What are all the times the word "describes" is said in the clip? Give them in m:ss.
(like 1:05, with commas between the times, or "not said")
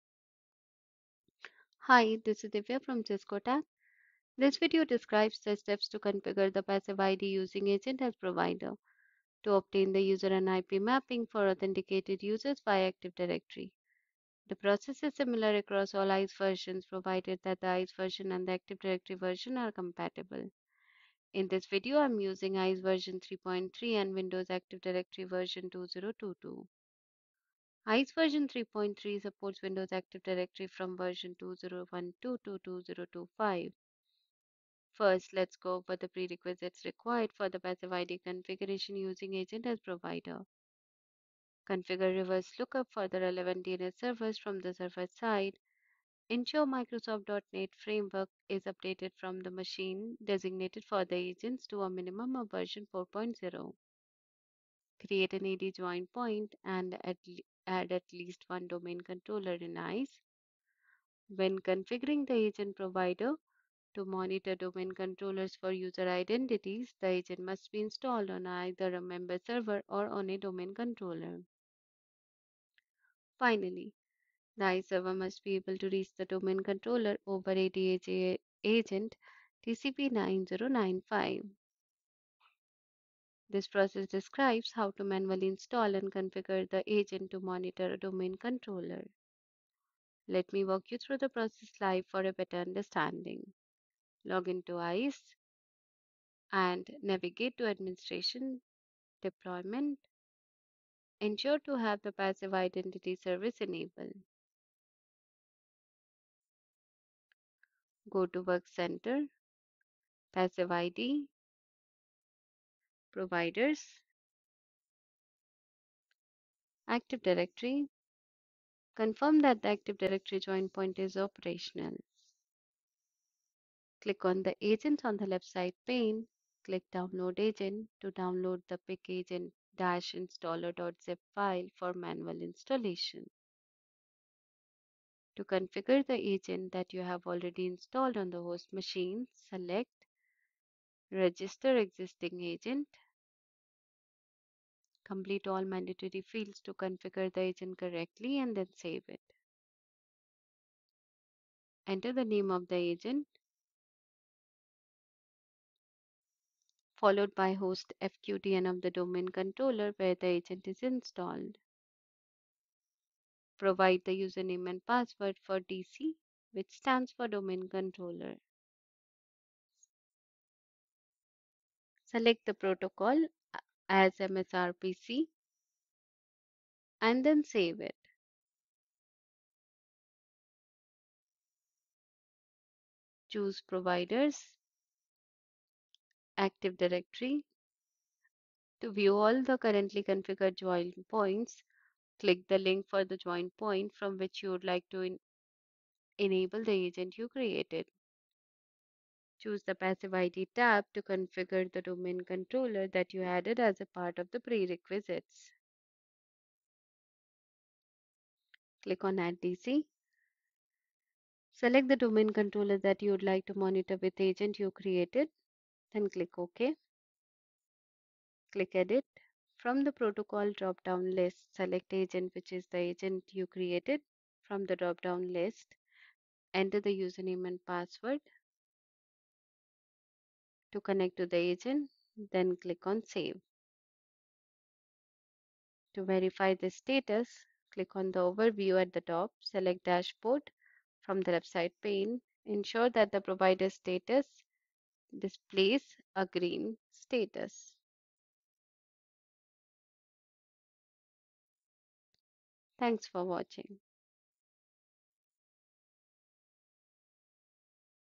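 0:04, 1:24.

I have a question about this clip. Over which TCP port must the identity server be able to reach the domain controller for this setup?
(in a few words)
9095.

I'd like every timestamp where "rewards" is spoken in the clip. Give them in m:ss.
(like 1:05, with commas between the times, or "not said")
not said.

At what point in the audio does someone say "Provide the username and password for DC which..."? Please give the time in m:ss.
2:43.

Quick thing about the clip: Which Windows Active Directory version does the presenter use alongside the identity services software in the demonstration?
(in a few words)
2022.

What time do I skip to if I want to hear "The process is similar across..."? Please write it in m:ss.
0:14.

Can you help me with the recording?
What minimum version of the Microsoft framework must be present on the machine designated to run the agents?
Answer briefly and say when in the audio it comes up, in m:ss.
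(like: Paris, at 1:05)
4.0, at 0:52.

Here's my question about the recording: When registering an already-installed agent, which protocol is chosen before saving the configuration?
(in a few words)
MSRPC.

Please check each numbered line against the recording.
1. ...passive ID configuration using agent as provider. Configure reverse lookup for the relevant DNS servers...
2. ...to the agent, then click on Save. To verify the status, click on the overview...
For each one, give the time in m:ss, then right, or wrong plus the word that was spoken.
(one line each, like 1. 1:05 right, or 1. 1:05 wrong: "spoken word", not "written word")
1. 0:37 right
2. 3:51 right.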